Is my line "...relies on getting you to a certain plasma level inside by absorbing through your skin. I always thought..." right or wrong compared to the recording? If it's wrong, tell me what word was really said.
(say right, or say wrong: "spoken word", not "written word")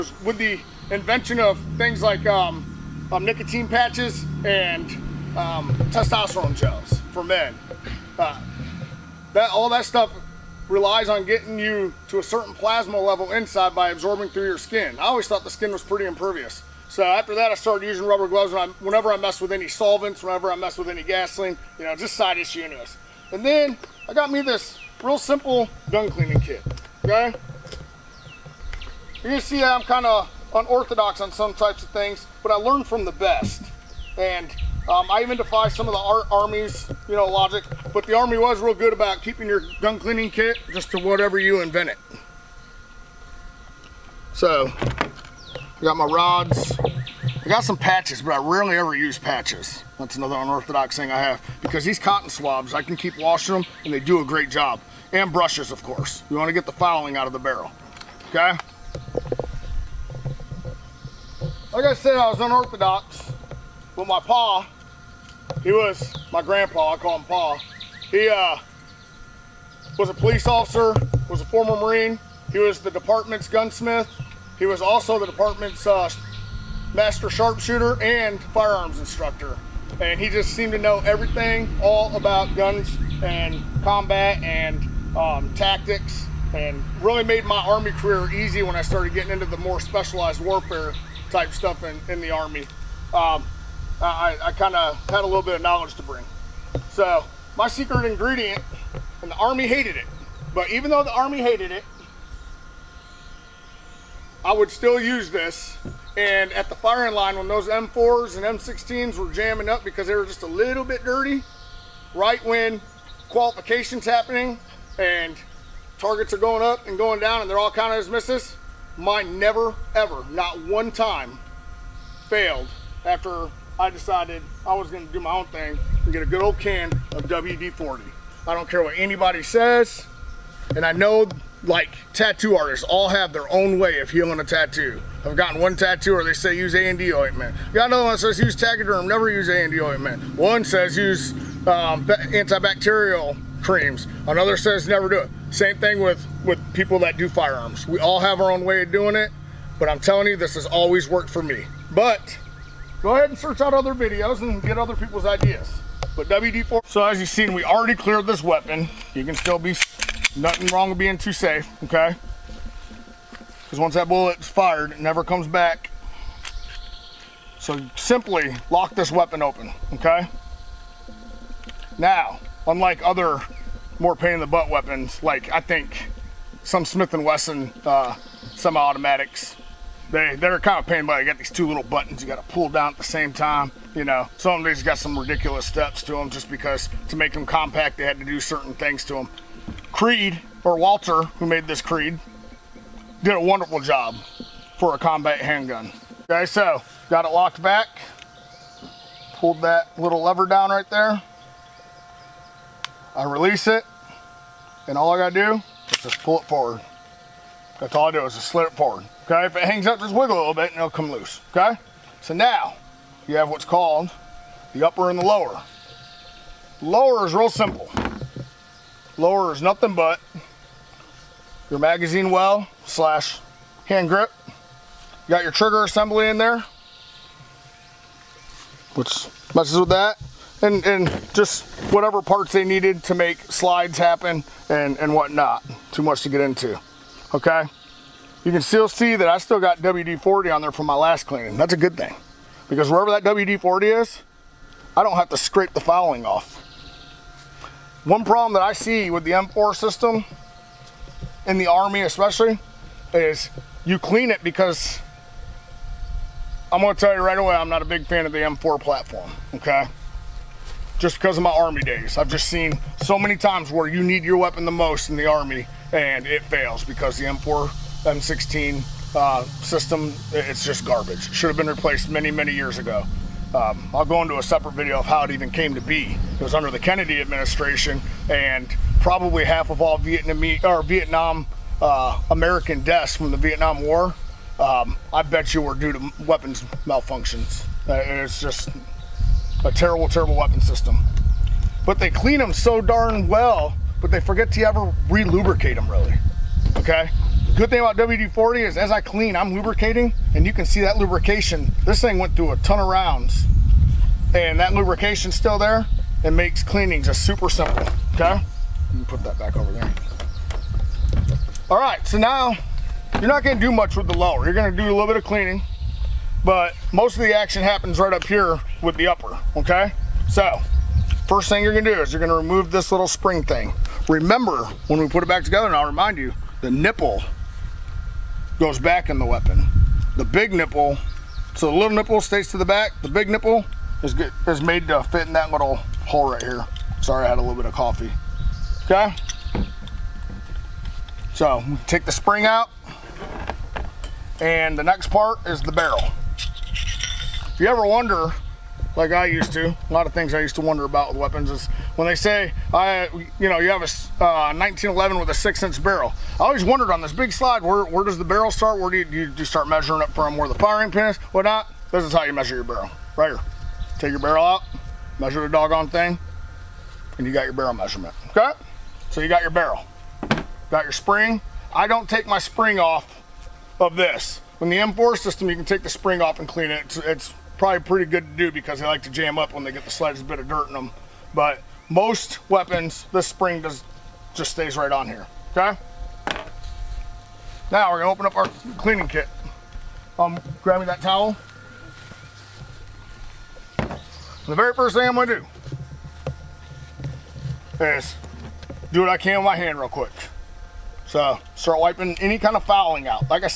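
right.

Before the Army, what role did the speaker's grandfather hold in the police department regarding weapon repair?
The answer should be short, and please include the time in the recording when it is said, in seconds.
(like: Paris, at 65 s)
department's gunsmith, at 72 s.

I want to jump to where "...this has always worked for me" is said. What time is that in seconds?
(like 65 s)
150 s.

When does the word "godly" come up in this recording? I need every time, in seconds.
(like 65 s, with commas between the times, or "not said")
not said.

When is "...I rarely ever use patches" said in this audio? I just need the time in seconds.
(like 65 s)
48 s.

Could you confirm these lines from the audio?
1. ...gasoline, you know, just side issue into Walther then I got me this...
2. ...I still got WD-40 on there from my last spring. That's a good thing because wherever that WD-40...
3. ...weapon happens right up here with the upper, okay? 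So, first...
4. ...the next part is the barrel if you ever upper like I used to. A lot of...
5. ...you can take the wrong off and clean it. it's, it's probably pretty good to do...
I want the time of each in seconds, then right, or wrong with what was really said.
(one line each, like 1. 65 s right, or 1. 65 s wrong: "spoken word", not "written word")
1. 21 s wrong: "And", not "Walther"
2. 239 s wrong: "cleaning", not "spring"
3. 317 s wrong: "action", not "weapon"
4. 344 s wrong: "wonder", not "upper"
5. 375 s wrong: "spring", not "wrong".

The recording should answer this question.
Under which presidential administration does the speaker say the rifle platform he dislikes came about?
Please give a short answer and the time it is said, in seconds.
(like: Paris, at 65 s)
Kennedy administration, at 276 s.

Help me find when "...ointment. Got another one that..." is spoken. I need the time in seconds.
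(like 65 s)
137 s.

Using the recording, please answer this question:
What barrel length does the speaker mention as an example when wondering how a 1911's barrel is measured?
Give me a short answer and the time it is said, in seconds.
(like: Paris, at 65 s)
6 inch, at 355 s.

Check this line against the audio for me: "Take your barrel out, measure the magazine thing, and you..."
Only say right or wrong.
wrong.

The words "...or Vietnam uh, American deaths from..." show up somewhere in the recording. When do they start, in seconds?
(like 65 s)
280 s.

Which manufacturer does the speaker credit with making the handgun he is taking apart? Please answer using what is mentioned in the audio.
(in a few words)
Walther.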